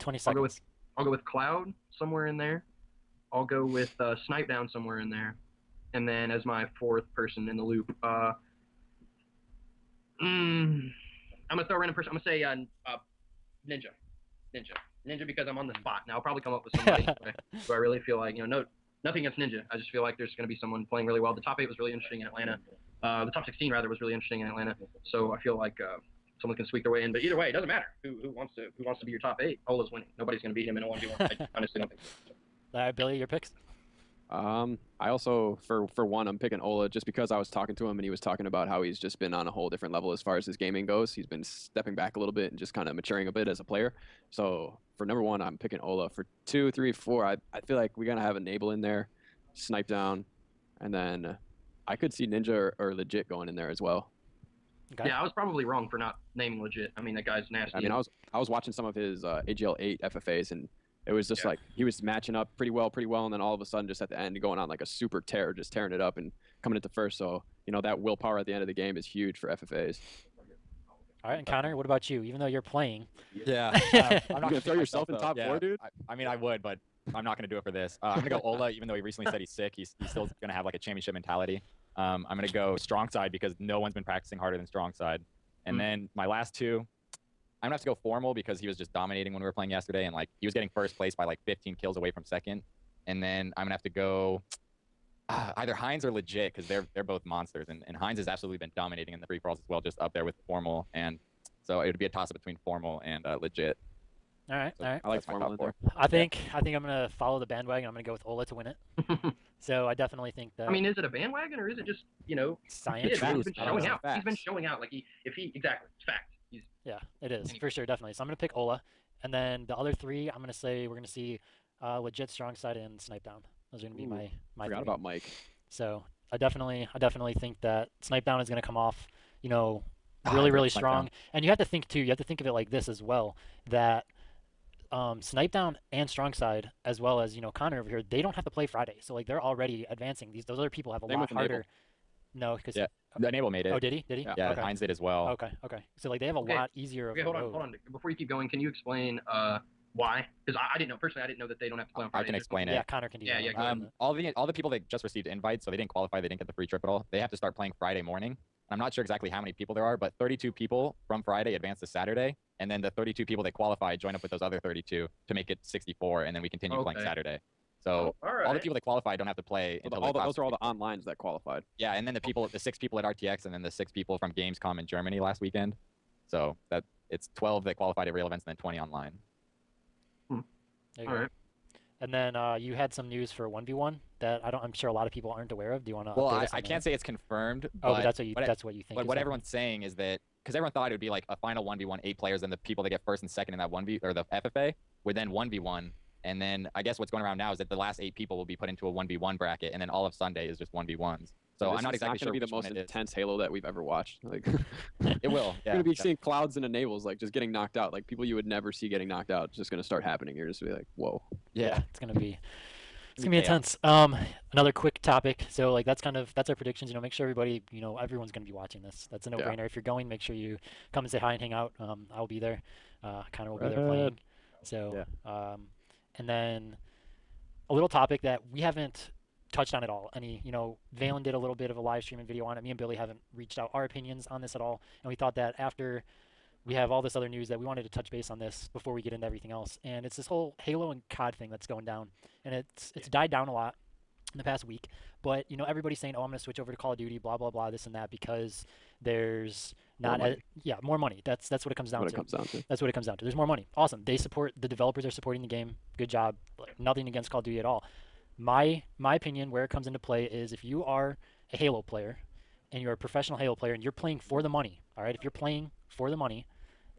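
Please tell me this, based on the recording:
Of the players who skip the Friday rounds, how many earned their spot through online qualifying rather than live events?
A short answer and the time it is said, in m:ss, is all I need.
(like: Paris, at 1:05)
20, at 2:58.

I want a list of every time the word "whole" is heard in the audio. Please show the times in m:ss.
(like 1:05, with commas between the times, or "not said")
0:39, 4:00.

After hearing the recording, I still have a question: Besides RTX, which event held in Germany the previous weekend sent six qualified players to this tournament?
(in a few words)
Gamescom.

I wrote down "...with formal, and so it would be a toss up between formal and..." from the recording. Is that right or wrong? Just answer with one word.
right.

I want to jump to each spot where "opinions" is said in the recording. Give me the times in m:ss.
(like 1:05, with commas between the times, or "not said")
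3:53, 4:19.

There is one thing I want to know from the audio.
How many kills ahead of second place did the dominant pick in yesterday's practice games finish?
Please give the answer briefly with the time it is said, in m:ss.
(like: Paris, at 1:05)
15, at 1:31.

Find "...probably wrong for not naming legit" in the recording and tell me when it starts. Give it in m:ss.
0:55.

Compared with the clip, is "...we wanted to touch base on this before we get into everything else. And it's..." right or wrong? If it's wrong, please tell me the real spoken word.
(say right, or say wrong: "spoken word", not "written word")
right.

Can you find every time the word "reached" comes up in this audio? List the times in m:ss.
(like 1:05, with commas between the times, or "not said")
3:53.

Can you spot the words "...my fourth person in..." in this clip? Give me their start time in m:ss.
0:06.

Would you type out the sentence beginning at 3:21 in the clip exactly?
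So this I'm not exactly not sure.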